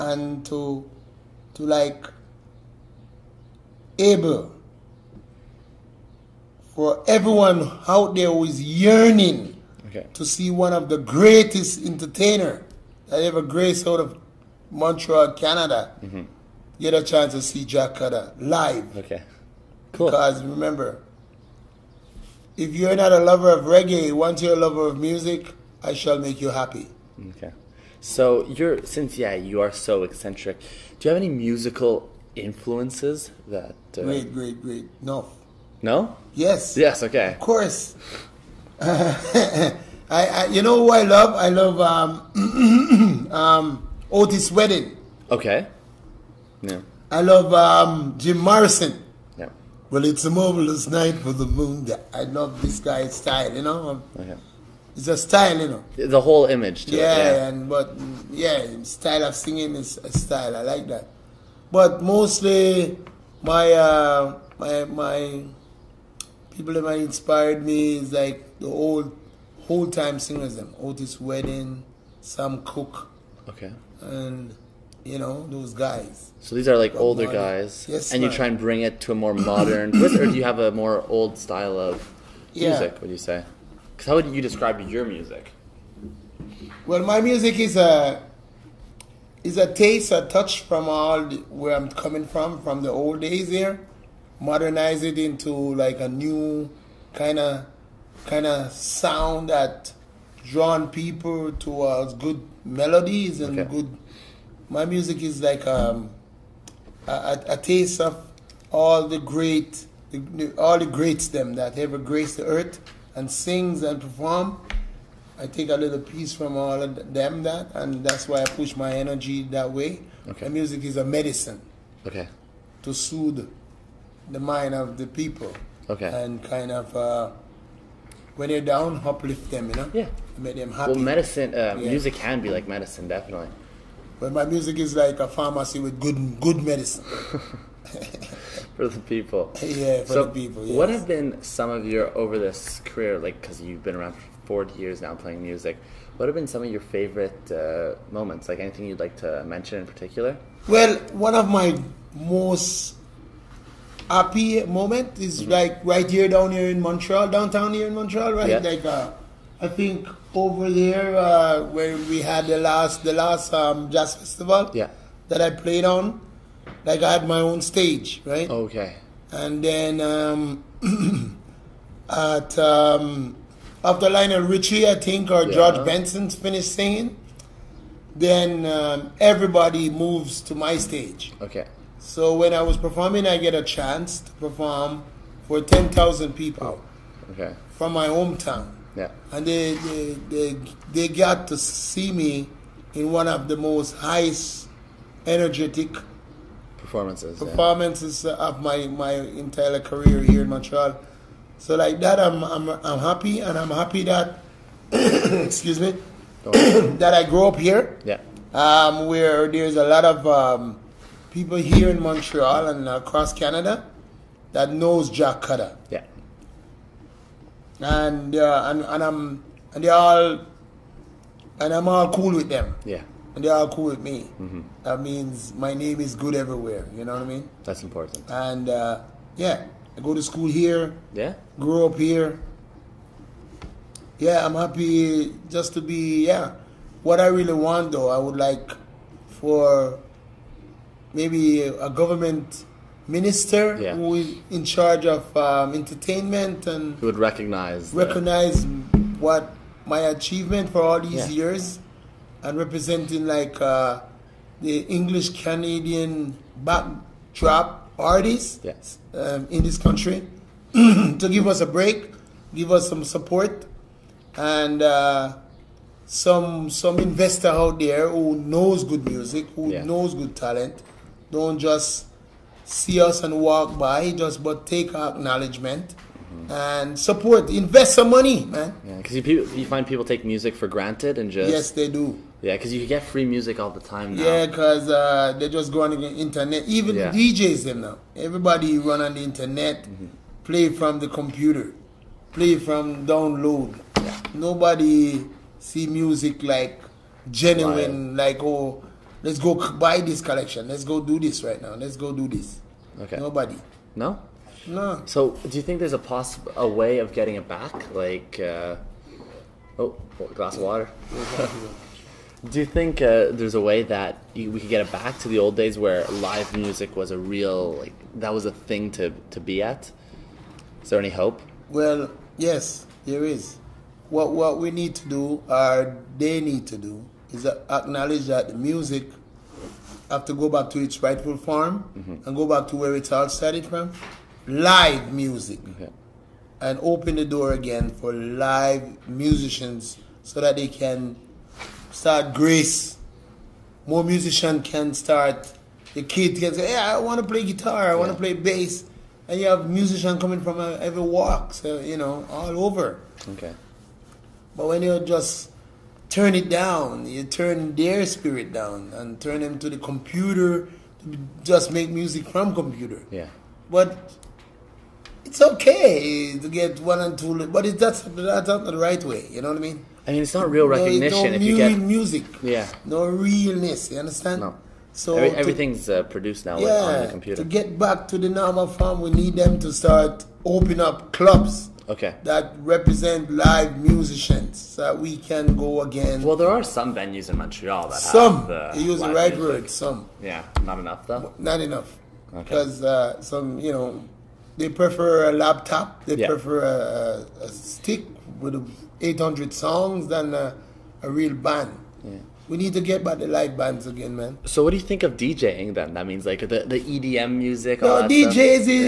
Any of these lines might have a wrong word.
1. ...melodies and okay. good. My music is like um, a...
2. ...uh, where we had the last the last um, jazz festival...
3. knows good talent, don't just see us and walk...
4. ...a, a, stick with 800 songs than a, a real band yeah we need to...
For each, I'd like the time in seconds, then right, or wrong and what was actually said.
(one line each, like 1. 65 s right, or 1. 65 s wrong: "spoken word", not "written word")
1. 102 s right
2. 161 s right
3. 269 s right
4. 396 s right.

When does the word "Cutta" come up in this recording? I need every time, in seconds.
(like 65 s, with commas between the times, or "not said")
17 s, 215 s.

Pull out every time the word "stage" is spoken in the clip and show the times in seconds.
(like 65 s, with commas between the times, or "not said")
167 s, 180 s.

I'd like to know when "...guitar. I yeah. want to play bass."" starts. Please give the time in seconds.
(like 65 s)
347 s.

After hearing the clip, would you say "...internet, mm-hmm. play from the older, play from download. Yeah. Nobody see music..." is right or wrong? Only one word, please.
wrong.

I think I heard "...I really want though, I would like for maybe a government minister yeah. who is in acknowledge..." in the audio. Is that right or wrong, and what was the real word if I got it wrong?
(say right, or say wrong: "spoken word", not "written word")
wrong: "charge", not "acknowledge".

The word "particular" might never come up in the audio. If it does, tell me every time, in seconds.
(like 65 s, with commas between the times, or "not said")
149 s.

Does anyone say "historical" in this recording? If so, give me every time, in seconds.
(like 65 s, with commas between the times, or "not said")
not said.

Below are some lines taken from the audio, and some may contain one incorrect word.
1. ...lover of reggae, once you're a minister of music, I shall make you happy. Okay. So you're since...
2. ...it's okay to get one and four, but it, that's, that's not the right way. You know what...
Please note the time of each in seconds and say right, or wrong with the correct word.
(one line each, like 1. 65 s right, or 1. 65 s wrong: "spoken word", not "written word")
1. 23 s wrong: "lover", not "minister"
2. 365 s wrong: "two", not "four".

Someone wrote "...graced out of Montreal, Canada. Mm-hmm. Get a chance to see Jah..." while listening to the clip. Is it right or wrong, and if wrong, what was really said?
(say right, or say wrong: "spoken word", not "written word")
right.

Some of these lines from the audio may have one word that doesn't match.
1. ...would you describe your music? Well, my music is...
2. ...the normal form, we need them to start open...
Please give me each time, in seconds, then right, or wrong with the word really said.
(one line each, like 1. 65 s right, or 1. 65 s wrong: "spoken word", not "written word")
1. 84 s right
2. 378 s right.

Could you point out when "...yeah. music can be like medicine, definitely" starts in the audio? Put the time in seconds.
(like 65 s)
131 s.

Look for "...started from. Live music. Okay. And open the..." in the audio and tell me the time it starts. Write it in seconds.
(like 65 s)
333 s.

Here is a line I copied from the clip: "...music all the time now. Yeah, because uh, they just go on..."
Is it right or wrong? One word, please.
right.